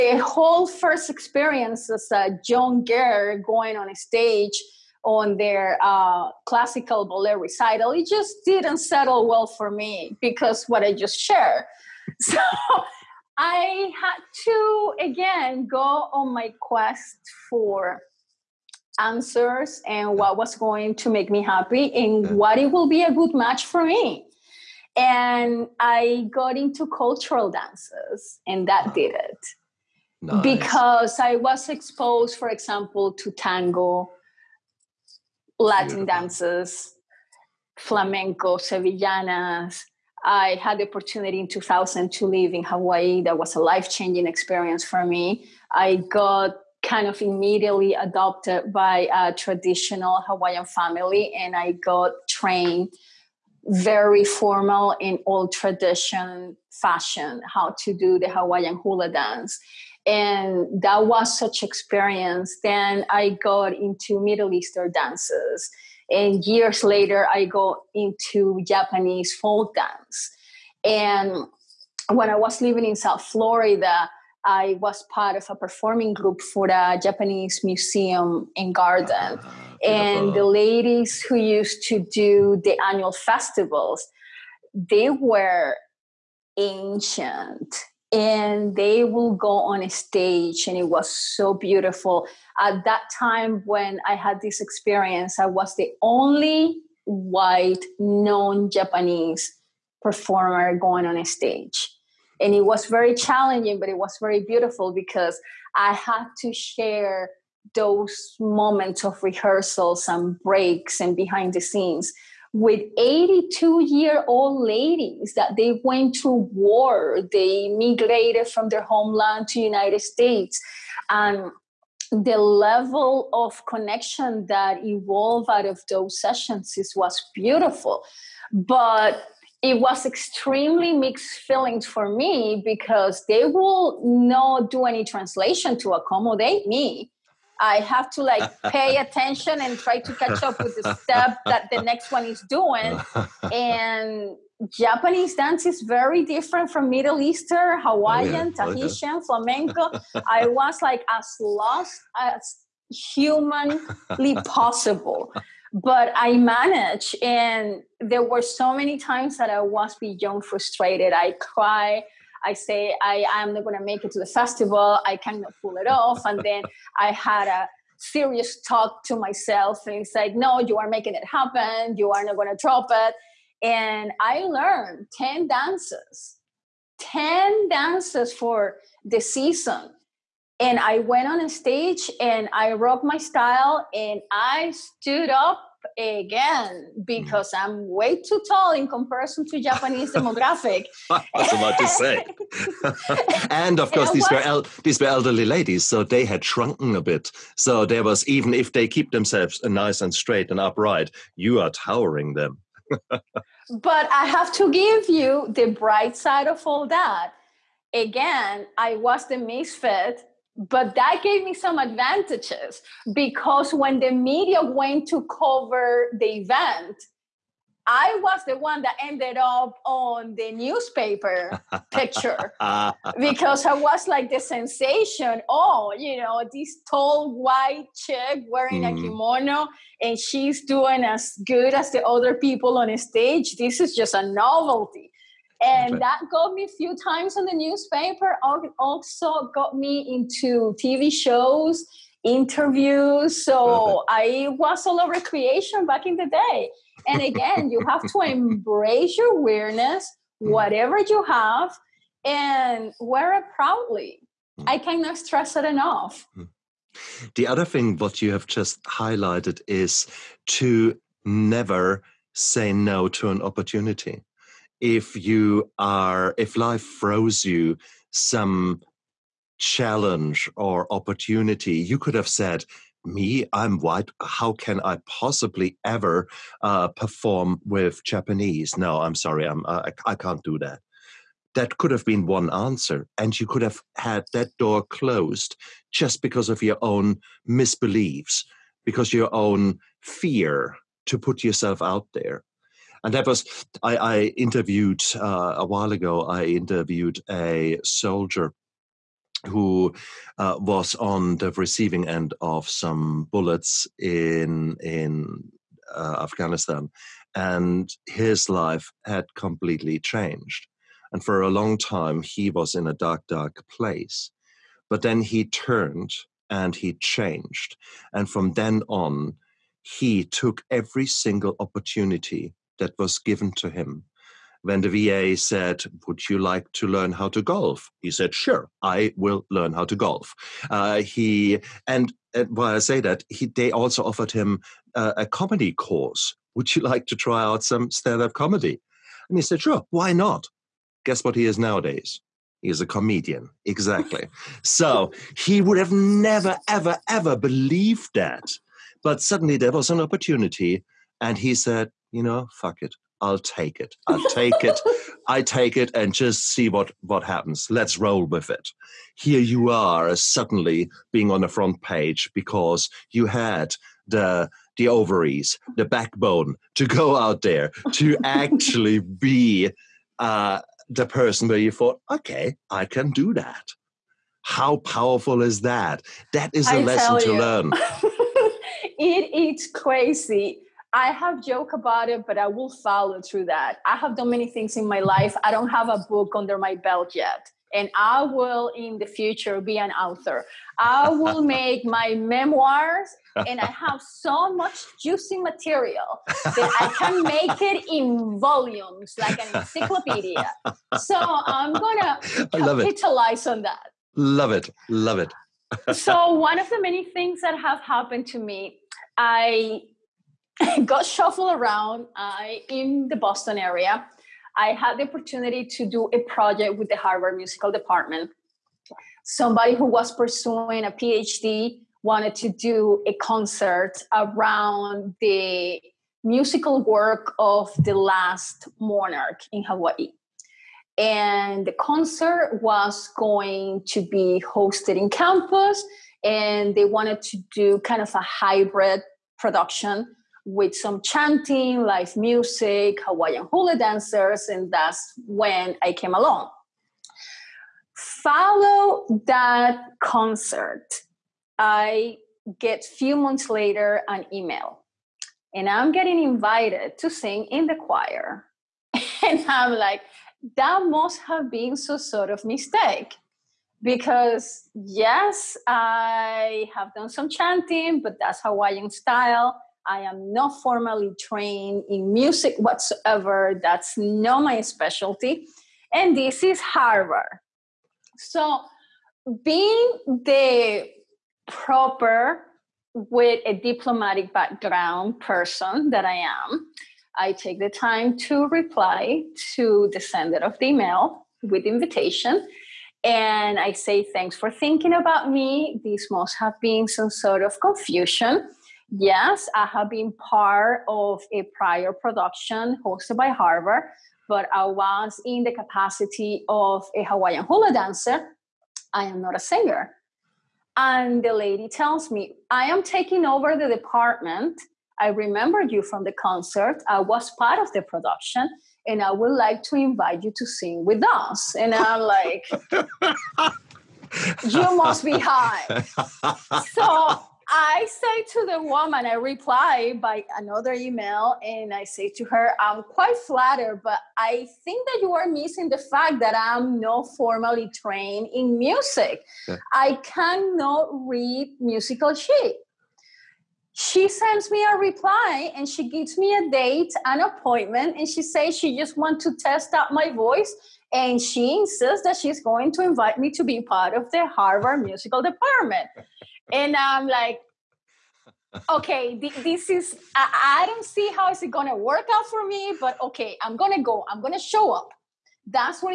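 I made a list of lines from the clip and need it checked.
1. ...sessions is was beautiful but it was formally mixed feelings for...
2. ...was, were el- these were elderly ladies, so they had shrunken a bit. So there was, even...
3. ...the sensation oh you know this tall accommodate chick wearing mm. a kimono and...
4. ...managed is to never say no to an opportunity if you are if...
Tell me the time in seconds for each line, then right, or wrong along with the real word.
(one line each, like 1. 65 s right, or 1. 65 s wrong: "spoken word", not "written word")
1. 126 s wrong: "extremely", not "formally"
2. 194 s right
3. 224 s wrong: "white", not "accommodate"
4. 258 s wrong: "highlighted", not "managed".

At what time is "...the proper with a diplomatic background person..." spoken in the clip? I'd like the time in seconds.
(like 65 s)
480 s.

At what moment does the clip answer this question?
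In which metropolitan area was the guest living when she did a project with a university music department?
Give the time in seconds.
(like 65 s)
413 s.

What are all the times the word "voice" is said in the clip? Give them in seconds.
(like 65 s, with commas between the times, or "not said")
550 s.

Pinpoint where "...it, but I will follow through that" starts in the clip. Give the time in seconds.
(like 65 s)
382 s.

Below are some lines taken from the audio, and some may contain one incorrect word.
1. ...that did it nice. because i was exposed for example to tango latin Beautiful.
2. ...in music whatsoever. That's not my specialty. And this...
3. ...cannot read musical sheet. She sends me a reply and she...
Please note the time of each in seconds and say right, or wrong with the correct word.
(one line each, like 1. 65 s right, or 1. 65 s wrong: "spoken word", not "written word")
1. 28 s right
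2. 471 s right
3. 540 s right.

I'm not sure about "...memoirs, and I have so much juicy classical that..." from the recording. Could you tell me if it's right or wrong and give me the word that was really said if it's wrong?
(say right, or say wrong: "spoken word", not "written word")
wrong: "material", not "classical".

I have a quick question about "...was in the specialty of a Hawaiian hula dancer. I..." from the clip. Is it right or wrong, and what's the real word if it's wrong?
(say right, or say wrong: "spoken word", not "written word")
wrong: "capacity", not "specialty".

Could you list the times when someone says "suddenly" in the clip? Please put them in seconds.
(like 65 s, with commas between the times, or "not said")
349 s, 360 s.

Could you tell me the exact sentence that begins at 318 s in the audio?
And from then on, he took every single opportunity that was given to him.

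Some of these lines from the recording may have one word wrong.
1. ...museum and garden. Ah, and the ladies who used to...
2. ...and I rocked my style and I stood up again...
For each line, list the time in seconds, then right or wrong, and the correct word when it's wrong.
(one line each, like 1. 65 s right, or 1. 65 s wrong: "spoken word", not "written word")
1. 77 s right
2. 182 s right.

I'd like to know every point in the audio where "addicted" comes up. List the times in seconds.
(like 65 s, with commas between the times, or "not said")
not said.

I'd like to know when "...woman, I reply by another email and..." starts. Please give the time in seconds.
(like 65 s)
528 s.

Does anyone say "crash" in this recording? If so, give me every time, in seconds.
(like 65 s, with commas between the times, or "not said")
not said.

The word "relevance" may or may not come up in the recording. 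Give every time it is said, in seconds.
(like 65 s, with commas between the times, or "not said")
not said.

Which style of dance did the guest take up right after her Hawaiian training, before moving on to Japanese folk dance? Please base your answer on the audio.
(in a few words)
Middle Eastern dances.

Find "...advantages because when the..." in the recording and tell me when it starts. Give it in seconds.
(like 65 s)
211 s.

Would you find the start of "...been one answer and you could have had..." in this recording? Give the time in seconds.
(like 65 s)
282 s.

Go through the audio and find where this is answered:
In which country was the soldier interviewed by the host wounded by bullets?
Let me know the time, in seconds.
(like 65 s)
306 s.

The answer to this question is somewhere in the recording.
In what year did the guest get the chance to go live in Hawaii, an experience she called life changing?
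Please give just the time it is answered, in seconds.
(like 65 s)
41 s.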